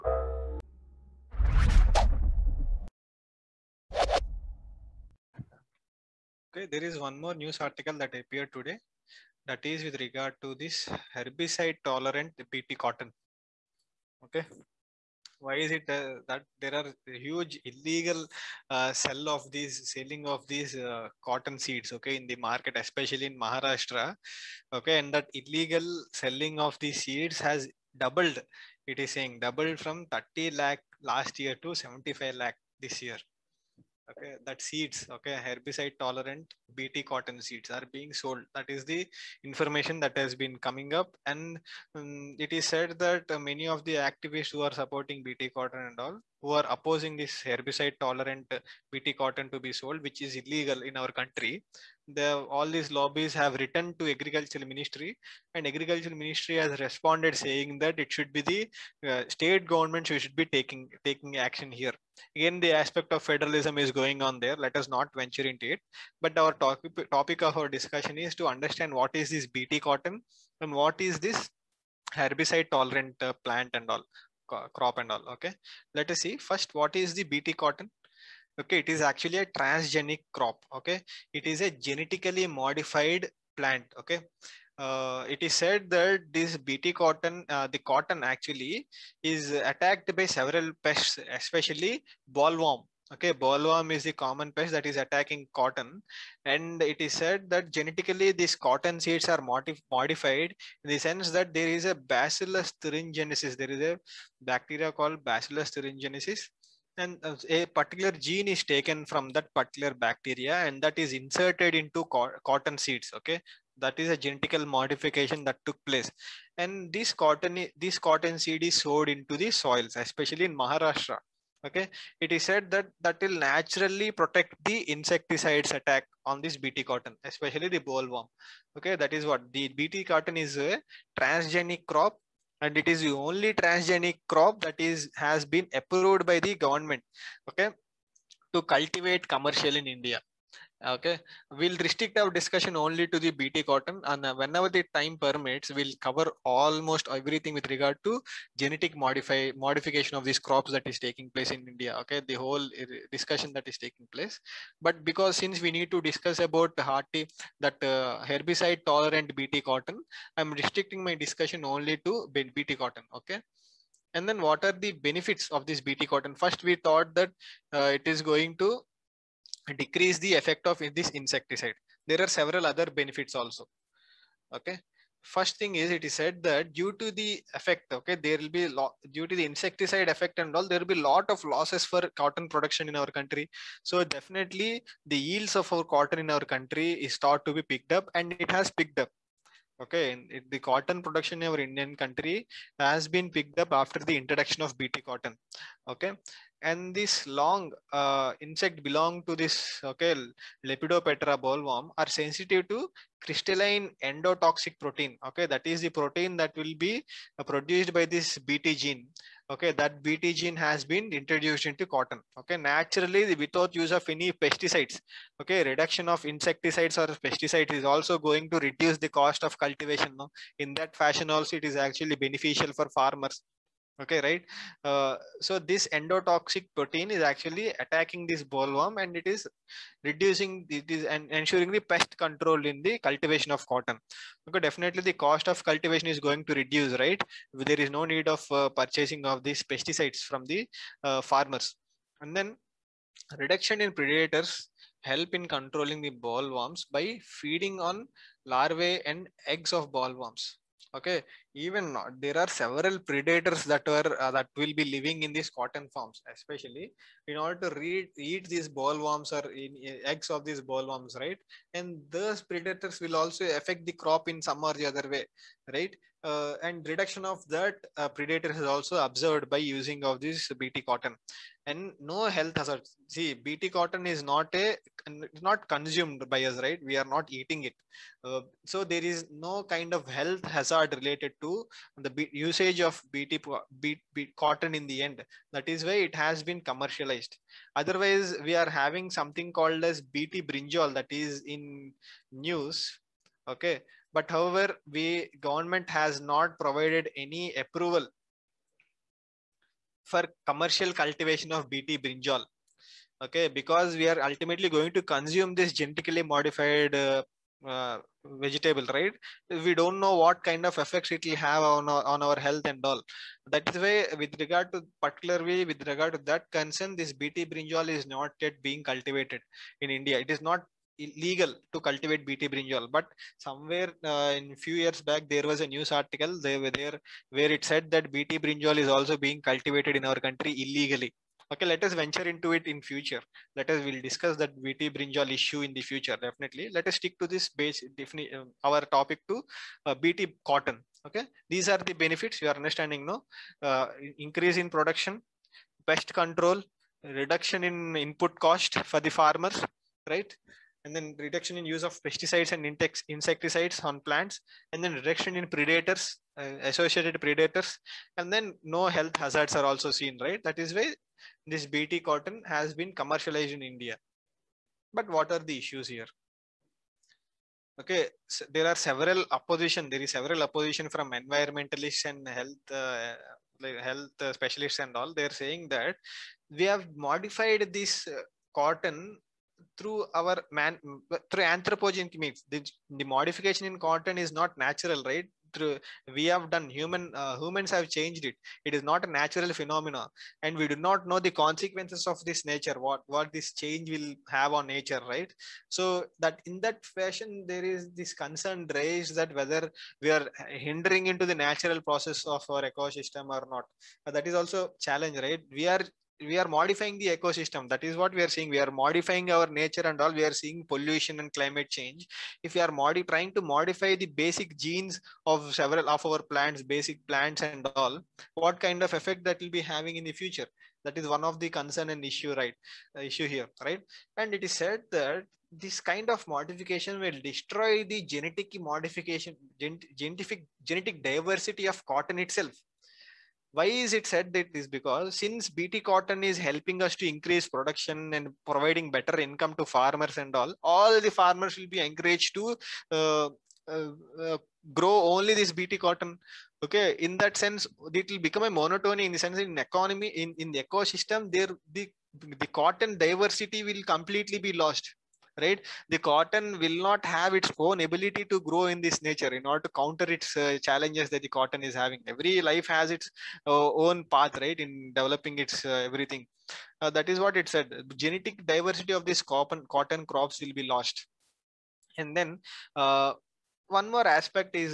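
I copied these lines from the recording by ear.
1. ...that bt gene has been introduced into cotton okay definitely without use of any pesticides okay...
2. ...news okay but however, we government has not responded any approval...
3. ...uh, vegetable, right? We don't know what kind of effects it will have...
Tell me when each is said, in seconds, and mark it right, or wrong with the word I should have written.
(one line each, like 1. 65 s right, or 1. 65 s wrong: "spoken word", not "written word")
1. 209 s wrong: "naturally", not "definitely"
2. 292 s wrong: "provided", not "responded"
3. 307 s right.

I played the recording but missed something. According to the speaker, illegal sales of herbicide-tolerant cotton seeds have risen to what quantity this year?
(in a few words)
75 lakh.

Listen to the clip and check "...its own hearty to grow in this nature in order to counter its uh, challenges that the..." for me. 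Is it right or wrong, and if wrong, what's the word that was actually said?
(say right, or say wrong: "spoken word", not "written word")
wrong: "ability", not "hearty".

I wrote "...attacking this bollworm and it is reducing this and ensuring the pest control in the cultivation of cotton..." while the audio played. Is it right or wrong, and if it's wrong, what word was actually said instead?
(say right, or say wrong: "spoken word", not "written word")
right.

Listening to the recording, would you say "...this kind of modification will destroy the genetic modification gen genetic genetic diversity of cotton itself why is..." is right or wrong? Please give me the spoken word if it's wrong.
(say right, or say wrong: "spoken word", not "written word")
right.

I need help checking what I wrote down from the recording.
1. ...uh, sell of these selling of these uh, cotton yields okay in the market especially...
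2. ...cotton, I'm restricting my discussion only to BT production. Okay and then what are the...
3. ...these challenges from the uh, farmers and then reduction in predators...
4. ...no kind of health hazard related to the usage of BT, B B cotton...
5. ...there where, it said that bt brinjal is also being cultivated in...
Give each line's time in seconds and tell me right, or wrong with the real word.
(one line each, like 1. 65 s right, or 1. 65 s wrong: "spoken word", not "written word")
1. 18 s wrong: "seeds", not "yields"
2. 159 s wrong: "cotton", not "production"
3. 239 s wrong: "pesticides", not "challenges"
4. 279 s right
5. 326 s right.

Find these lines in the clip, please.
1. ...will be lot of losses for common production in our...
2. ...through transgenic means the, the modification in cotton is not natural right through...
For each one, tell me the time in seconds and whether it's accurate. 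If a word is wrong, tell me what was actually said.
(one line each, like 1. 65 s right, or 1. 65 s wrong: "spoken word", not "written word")
1. 180 s wrong: "cotton", not "common"
2. 381 s wrong: "anthropogenic", not "transgenic".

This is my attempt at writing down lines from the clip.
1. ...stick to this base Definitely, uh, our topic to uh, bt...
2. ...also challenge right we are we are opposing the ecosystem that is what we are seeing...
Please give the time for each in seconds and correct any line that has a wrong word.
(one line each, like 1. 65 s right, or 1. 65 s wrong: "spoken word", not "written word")
1. 336 s right
2. 404 s wrong: "modifying", not "opposing".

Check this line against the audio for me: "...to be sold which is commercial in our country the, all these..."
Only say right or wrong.
wrong.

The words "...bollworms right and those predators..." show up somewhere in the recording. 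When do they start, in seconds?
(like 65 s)
260 s.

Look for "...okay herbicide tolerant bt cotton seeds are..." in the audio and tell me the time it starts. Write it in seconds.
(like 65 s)
35 s.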